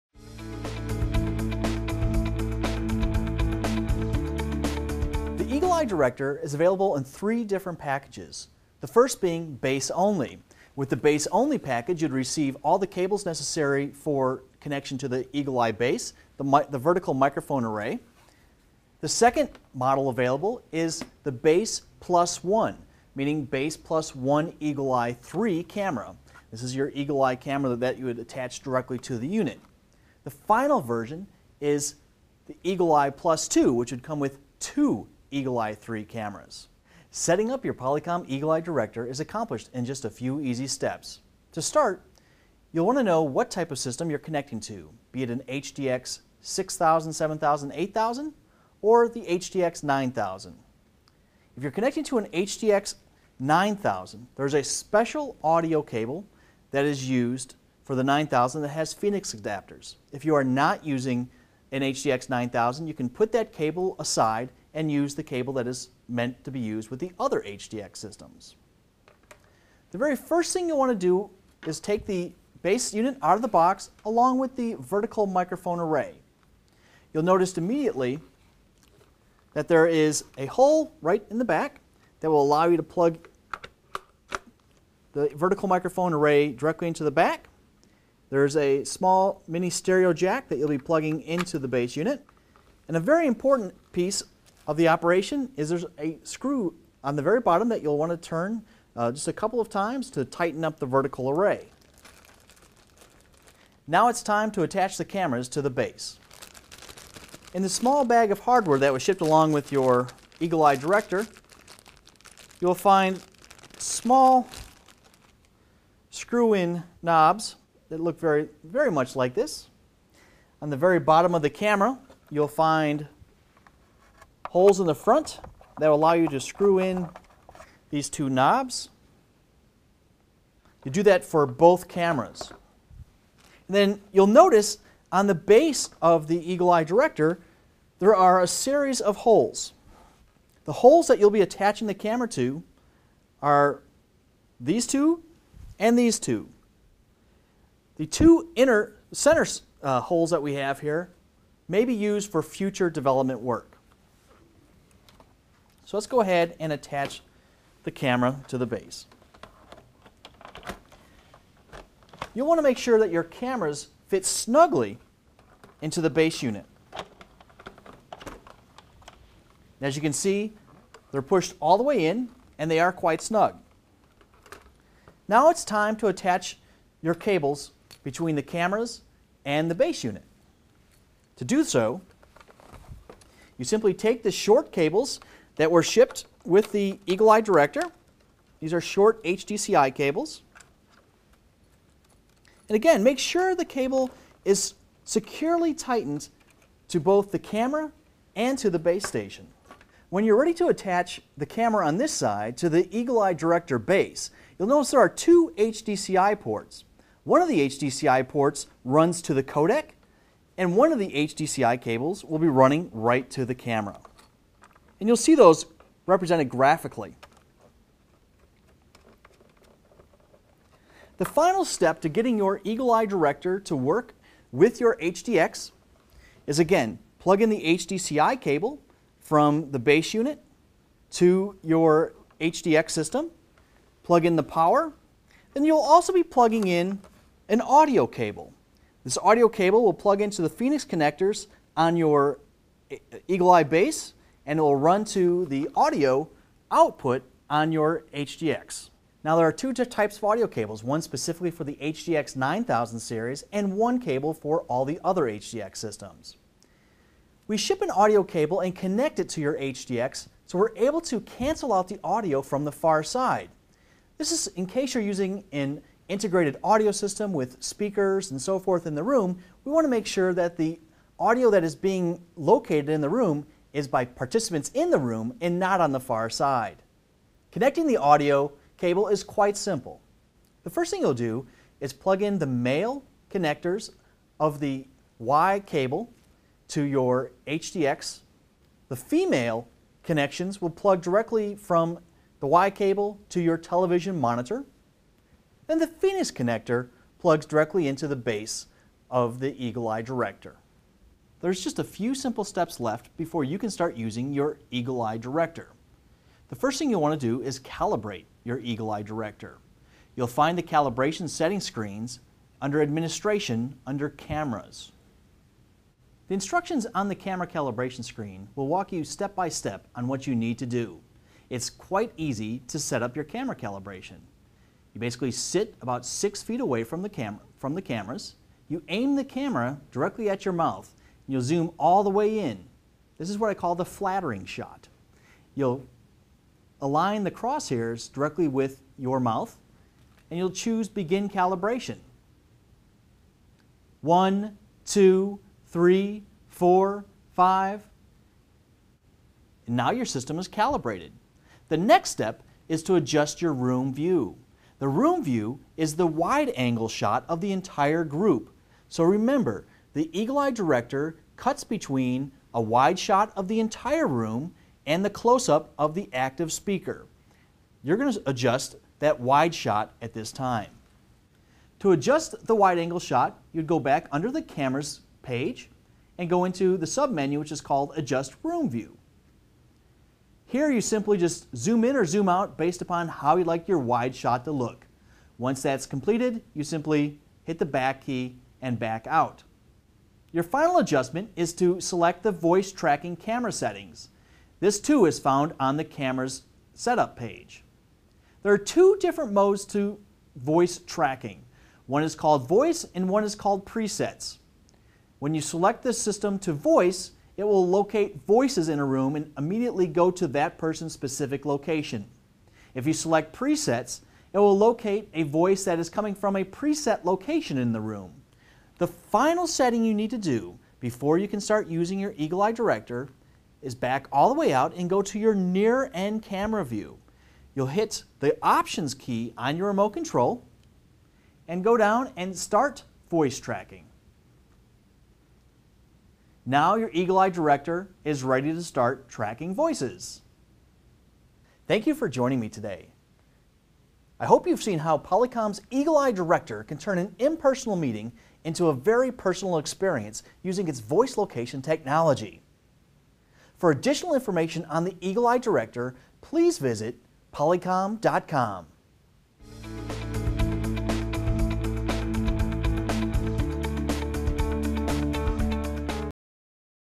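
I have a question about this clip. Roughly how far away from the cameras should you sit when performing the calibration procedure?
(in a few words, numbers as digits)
6 feet.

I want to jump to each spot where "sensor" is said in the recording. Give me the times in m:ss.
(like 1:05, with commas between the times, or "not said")
not said.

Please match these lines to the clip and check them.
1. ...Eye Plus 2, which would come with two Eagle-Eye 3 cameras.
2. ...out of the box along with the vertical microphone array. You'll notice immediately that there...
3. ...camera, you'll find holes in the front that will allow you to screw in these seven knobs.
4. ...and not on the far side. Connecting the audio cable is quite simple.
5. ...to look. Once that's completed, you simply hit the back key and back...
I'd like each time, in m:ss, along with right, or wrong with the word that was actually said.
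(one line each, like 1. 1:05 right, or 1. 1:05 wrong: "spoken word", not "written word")
1. 0:32 right
2. 1:13 right
3. 2:01 wrong: "two", not "seven"
4. 4:35 right
5. 6:24 right.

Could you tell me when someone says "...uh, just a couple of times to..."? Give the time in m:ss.
1:38.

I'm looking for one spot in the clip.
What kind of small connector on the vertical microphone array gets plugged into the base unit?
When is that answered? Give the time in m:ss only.
1:29.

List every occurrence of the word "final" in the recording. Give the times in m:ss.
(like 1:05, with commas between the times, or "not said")
0:30, 3:41, 6:30, 6:58.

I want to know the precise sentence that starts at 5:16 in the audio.
The instructions on the camera calibration screen will walk you step by step on what you need to do.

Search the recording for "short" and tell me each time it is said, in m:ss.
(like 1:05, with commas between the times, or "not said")
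3:04, 3:08.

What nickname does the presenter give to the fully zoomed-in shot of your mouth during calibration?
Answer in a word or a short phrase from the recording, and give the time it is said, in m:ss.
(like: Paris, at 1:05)
the flattering shot, at 5:33.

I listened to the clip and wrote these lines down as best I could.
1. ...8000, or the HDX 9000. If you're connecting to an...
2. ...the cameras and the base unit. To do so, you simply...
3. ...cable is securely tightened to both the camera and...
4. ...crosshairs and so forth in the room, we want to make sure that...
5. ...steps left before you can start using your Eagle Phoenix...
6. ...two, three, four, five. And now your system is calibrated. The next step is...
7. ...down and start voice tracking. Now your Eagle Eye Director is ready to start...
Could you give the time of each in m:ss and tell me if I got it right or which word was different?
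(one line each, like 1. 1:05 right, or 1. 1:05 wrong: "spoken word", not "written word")
1. 0:47 right
2. 2:58 right
3. 3:13 right
4. 4:27 wrong: "speakers", not "crosshairs"
5. 5:02 wrong: "Eye", not "Phoenix"
6. 5:44 right
7. 7:11 right.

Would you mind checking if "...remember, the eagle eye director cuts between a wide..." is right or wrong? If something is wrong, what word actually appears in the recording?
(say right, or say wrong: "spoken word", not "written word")
right.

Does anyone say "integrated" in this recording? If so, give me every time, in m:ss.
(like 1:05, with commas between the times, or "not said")
4:26.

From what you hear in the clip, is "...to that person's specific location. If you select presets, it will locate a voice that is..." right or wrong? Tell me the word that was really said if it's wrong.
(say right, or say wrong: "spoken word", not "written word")
right.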